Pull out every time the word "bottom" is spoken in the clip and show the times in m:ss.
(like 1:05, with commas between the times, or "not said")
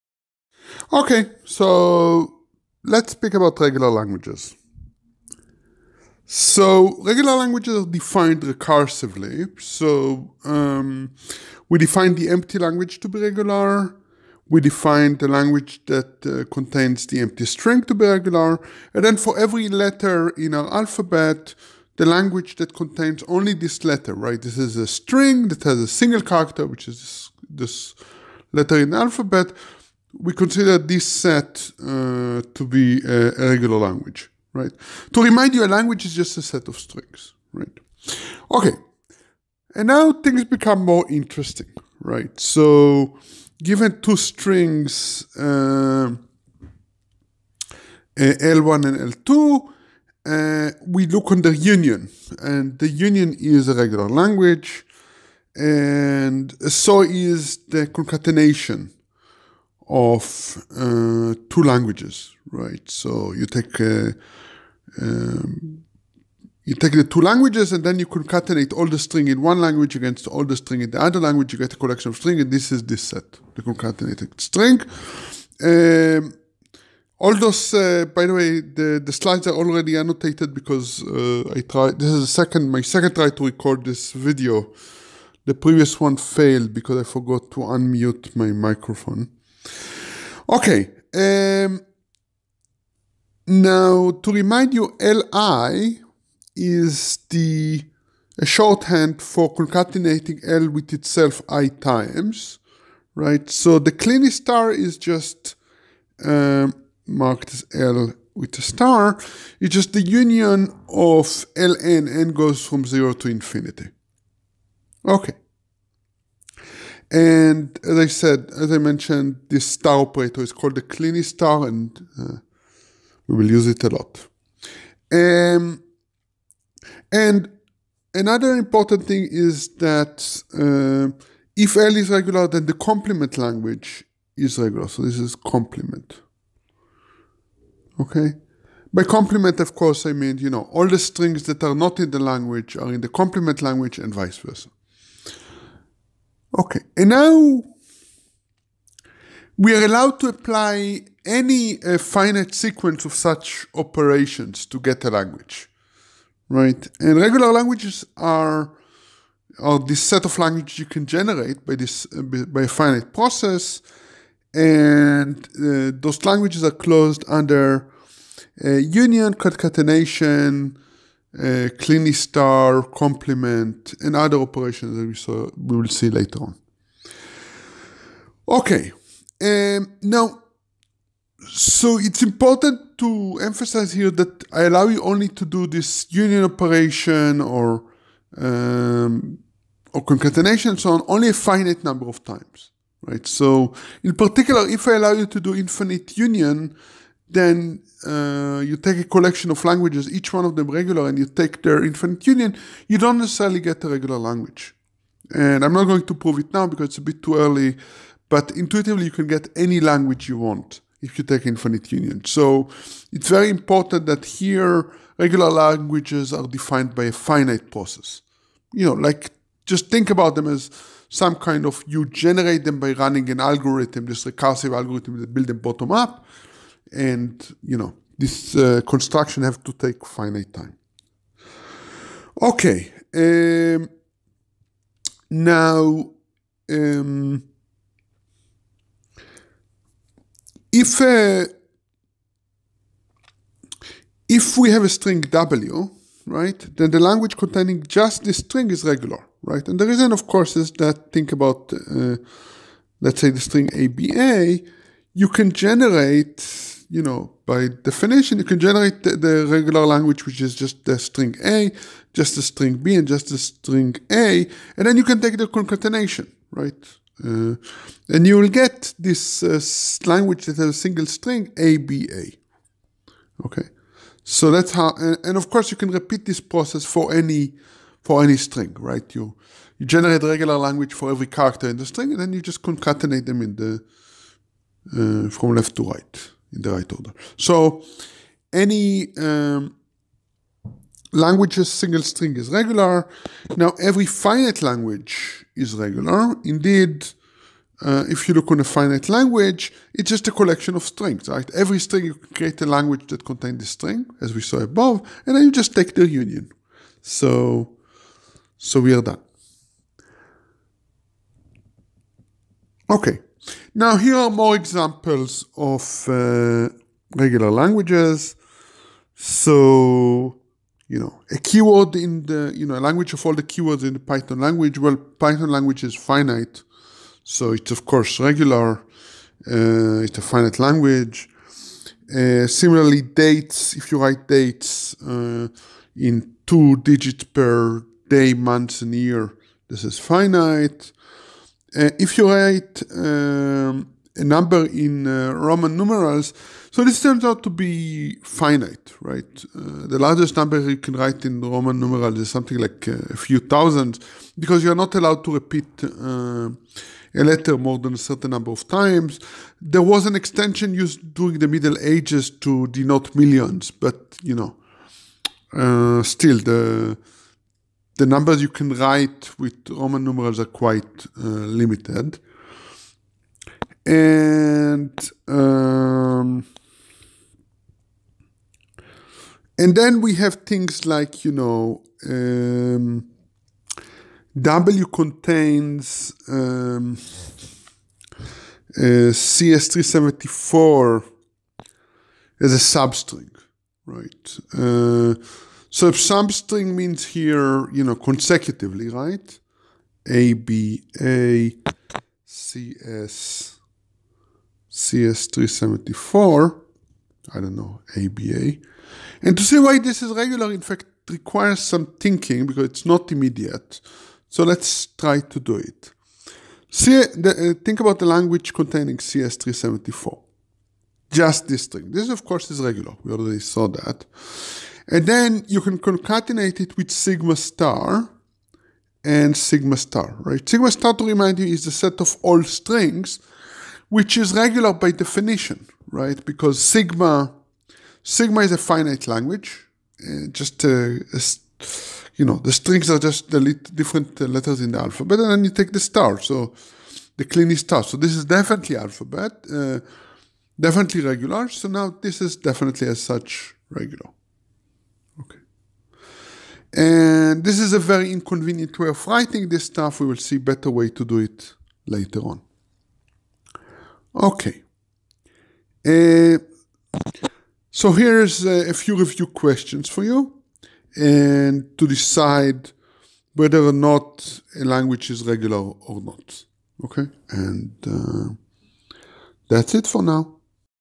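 3:45.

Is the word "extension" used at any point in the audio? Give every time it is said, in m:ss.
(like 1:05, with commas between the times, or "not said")
6:00.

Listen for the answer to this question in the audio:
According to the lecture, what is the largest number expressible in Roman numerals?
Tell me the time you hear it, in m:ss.
5:52.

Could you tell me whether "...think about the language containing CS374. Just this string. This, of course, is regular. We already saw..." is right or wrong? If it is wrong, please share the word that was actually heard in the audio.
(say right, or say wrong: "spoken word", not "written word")
right.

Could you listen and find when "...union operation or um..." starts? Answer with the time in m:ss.
3:06.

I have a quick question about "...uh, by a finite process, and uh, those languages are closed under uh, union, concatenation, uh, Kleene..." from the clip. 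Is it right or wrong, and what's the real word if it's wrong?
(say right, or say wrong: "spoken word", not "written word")
right.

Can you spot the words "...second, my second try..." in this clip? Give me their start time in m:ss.
1:22.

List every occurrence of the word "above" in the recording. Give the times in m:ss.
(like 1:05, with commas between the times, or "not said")
5:04.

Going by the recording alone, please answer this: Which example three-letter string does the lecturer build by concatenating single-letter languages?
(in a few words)
ABA.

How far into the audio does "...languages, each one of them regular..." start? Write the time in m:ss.
3:19.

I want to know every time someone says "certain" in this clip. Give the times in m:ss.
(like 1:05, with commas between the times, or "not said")
5:57.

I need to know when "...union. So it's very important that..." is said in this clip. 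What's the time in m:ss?
3:31.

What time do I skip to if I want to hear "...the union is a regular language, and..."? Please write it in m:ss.
0:52.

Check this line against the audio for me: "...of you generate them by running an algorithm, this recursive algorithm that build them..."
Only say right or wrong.
right.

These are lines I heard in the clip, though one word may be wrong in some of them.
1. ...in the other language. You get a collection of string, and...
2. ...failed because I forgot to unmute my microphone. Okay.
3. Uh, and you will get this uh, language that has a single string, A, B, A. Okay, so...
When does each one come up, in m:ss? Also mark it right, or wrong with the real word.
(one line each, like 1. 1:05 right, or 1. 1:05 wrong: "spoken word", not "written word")
1. 1:10 right
2. 1:26 right
3. 4:27 right.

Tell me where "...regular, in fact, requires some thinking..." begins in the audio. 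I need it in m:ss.
6:50.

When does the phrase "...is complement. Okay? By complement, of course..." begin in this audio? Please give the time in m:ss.
2:15.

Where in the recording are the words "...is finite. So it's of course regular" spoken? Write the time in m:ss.
5:25.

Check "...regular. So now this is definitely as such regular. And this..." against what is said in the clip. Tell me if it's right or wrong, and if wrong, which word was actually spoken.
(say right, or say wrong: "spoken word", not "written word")
right.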